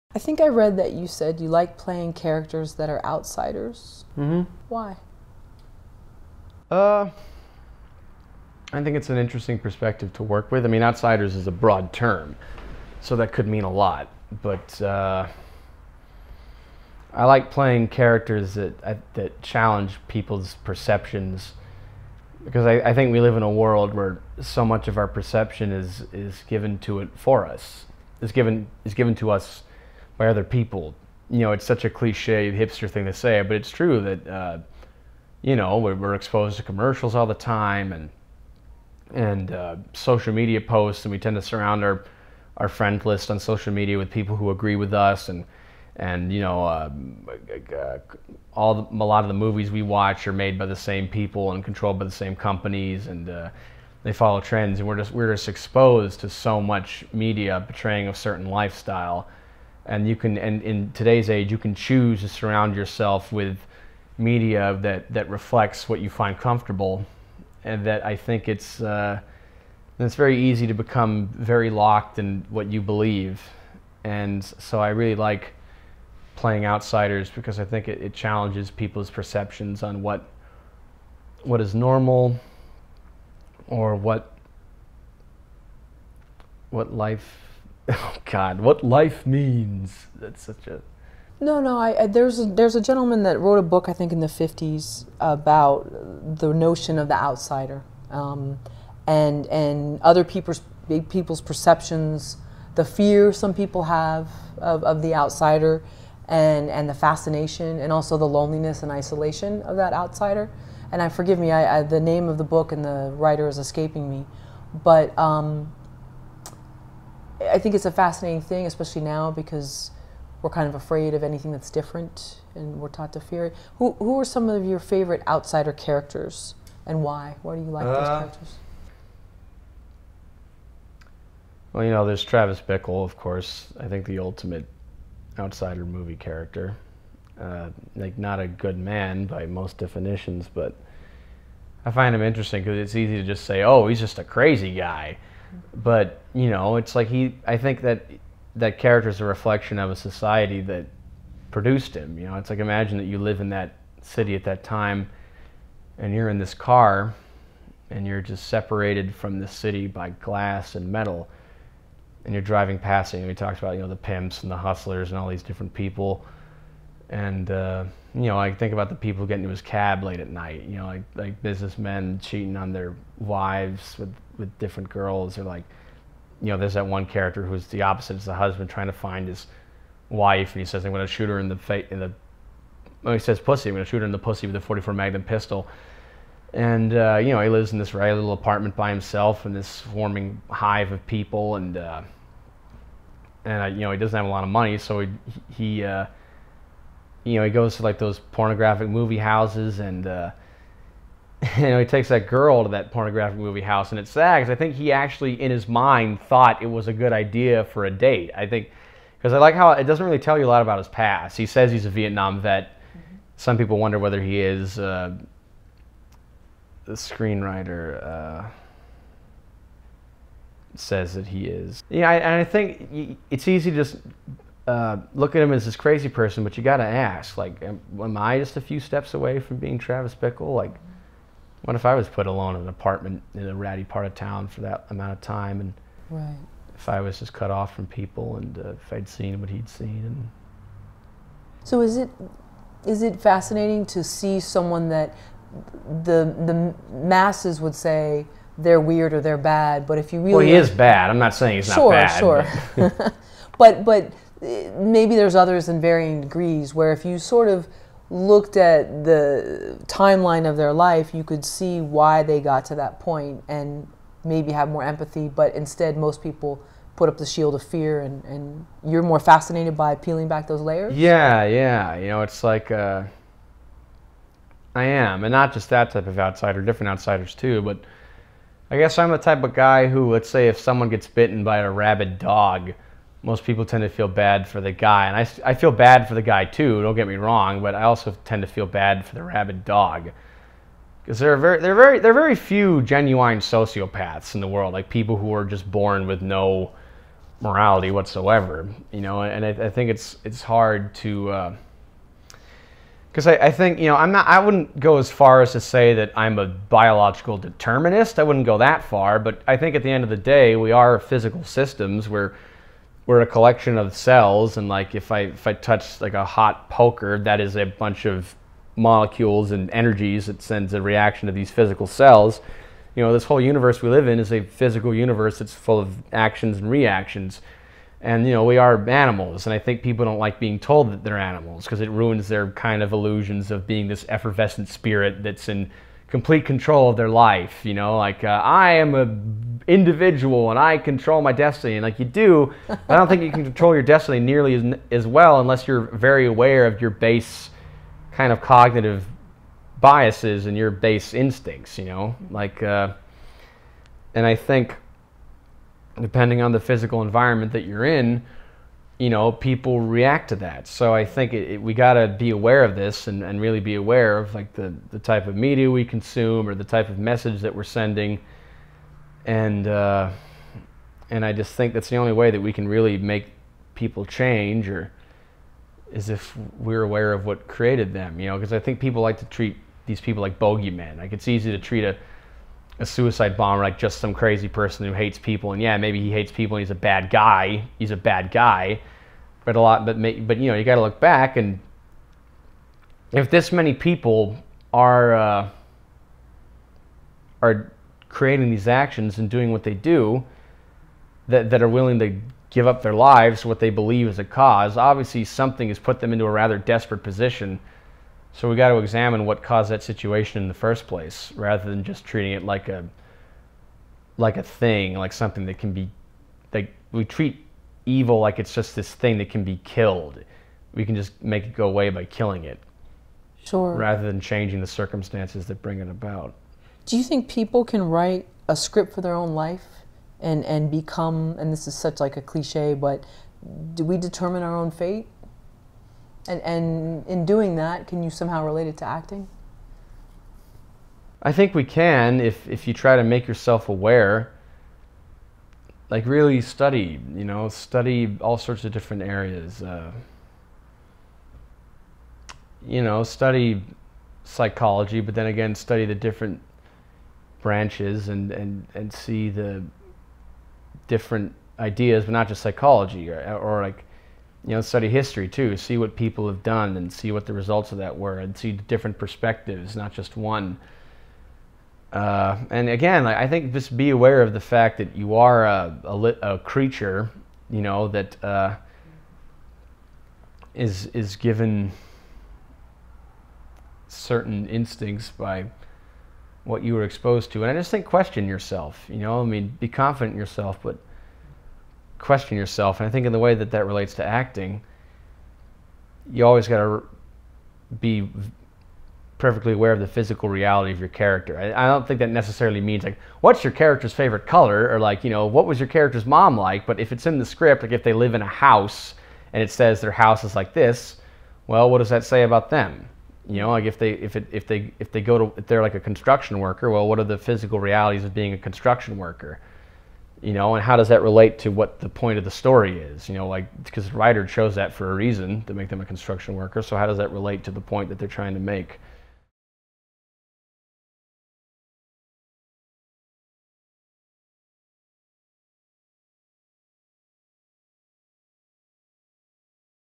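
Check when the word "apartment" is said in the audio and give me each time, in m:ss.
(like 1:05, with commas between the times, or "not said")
3:08, 3:52.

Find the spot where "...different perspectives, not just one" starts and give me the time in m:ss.
7:48.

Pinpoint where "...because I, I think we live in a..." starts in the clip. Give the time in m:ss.
0:22.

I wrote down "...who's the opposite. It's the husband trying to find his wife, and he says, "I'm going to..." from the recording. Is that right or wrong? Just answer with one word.
right.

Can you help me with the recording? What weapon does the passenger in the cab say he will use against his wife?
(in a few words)
44 Magnum pistol.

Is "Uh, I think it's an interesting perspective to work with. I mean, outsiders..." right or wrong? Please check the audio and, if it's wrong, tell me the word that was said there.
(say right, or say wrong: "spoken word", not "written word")
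right.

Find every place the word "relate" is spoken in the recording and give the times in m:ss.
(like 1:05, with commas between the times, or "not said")
7:18, 8:13, 8:41, 8:47.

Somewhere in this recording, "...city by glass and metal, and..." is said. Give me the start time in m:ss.
2:39.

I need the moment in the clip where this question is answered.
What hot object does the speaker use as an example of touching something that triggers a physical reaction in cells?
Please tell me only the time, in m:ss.
5:16.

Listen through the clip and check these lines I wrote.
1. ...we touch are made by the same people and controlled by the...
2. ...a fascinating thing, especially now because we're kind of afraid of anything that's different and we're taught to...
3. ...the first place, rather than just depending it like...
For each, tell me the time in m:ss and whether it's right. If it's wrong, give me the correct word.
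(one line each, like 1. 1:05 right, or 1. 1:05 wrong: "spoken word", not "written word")
1. 0:49 wrong: "watch", not "touch"
2. 1:57 right
3. 6:50 wrong: "treating", not "depending".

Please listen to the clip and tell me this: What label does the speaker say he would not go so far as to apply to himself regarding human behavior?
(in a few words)
biological determinist.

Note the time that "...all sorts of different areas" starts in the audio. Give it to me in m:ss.
7:28.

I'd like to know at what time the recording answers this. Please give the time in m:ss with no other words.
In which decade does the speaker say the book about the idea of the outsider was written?
1:34.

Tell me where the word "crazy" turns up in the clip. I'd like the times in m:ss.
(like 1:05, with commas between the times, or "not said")
2:24, 3:45, 6:24.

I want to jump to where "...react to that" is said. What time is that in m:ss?
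5:59.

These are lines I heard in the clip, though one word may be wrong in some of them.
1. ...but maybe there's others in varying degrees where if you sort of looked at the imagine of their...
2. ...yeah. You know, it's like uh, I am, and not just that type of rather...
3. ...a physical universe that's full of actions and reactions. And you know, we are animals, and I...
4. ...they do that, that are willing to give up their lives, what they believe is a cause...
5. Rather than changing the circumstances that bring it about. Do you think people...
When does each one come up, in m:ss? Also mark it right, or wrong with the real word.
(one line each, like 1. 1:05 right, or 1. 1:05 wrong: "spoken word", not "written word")
1. 4:13 wrong: "timeline", not "imagine"
2. 4:31 wrong: "outsider", not "rather"
3. 5:24 right
4. 6:39 right
5. 7:03 right.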